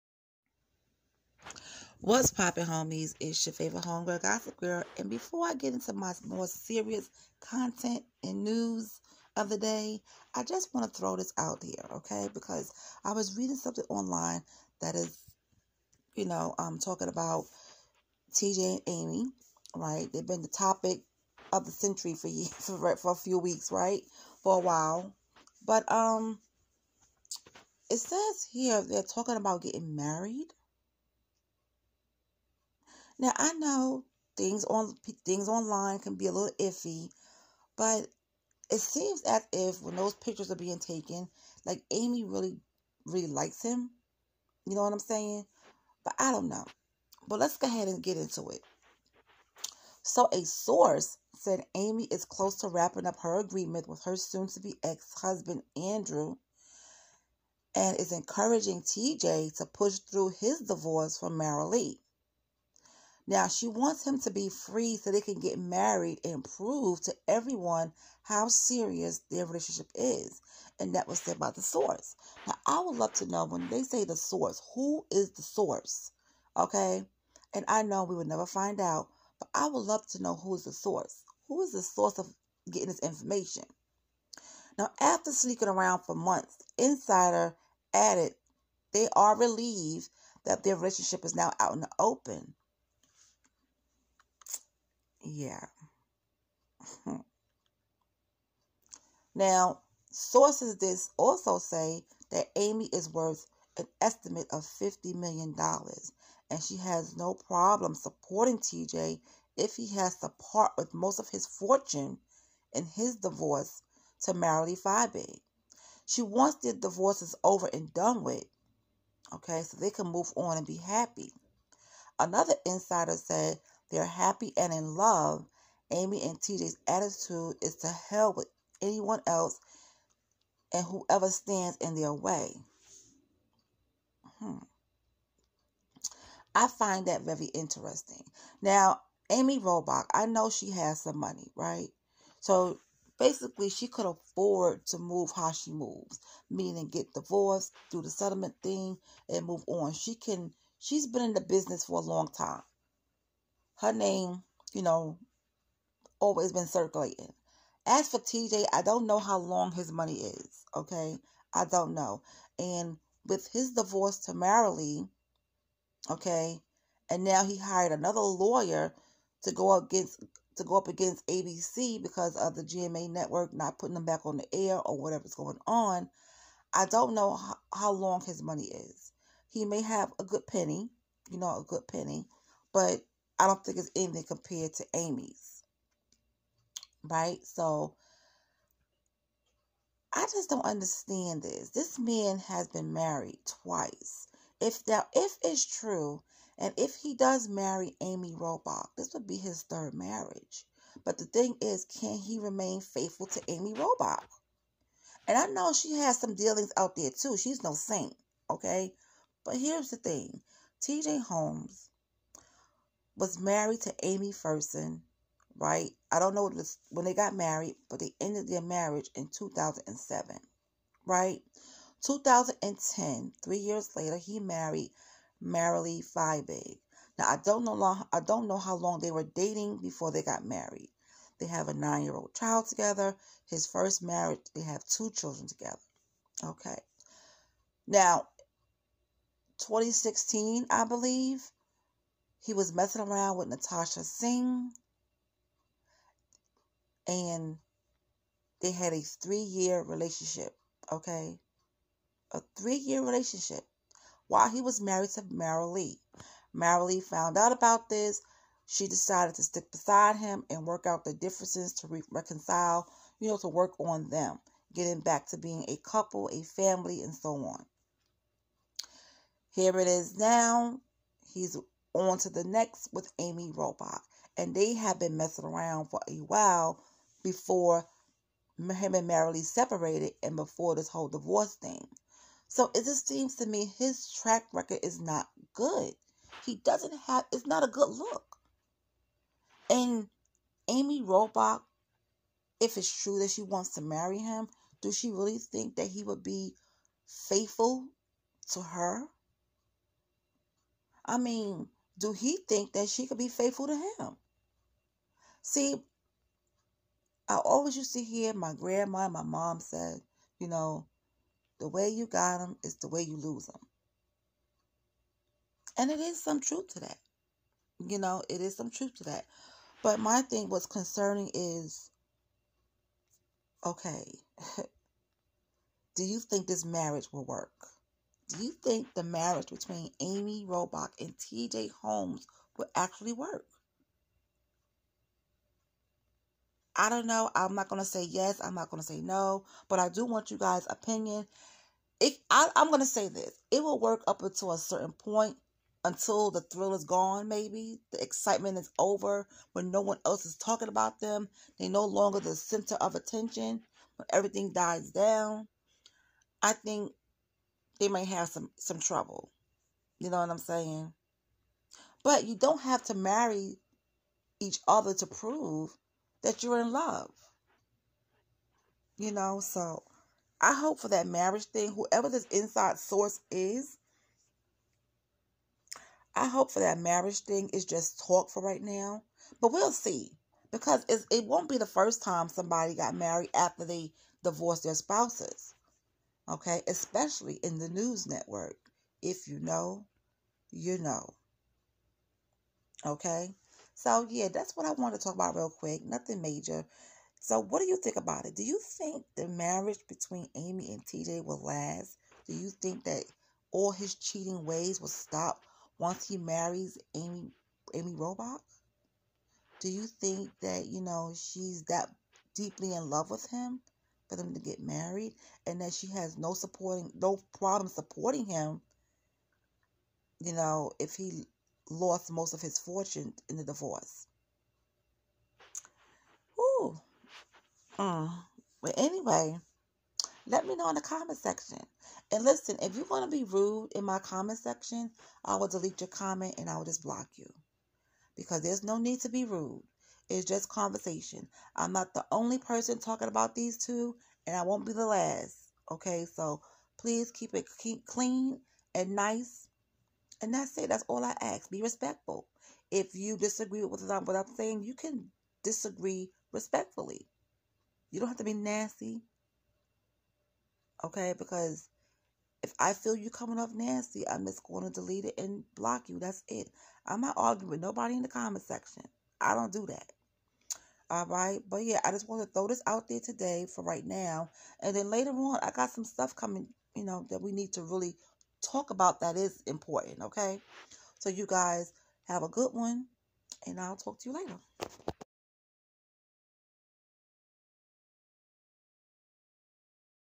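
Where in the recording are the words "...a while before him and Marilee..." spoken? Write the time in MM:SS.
04:36.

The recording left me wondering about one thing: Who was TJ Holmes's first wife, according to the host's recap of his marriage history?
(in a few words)
Amy Ferson.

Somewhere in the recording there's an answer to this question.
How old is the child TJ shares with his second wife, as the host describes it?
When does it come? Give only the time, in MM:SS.
03:51.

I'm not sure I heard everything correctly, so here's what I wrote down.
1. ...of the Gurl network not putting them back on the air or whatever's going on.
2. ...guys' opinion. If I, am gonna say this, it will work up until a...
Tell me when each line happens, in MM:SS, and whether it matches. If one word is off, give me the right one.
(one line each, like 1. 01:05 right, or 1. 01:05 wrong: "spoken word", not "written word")
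1. 02:52 wrong: "GMA", not "Gurl"
2. 05:40 right.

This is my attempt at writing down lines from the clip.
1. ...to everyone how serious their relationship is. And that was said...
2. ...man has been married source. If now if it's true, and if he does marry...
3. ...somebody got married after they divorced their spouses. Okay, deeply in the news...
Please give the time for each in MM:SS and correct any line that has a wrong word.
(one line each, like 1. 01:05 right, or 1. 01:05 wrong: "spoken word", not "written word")
1. 01:07 right
2. 03:11 wrong: "twice", not "source"
3. 06:22 wrong: "especially", not "deeply".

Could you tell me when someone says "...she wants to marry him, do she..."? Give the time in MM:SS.
04:53.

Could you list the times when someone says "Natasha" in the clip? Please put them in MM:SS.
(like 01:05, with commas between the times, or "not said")
04:03.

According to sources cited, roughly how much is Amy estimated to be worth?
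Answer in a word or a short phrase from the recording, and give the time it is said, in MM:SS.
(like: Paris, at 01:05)
$50 million, at 01:44.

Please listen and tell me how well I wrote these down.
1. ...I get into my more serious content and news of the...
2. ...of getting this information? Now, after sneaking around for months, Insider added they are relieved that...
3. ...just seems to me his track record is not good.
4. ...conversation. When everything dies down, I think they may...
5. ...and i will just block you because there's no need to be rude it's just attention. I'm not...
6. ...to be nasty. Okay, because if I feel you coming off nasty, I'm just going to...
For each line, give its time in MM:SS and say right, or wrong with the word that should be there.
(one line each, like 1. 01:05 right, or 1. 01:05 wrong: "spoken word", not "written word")
1. 00:05 right
2. 01:22 right
3. 04:42 right
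4. 05:52 wrong: "attention", not "conversation"
5. 07:16 wrong: "conversation", not "attention"
6. 07:38 right.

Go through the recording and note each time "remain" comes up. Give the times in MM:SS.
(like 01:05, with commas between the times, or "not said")
03:22.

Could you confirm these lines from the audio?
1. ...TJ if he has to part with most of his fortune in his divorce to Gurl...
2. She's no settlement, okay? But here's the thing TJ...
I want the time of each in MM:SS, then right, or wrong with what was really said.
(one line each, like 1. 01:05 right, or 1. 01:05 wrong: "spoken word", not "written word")
1. 01:48 wrong: "Marilee", not "Gurl"
2. 03:27 wrong: "saint", not "settlement".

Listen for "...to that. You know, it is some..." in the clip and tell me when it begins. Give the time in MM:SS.
05:16.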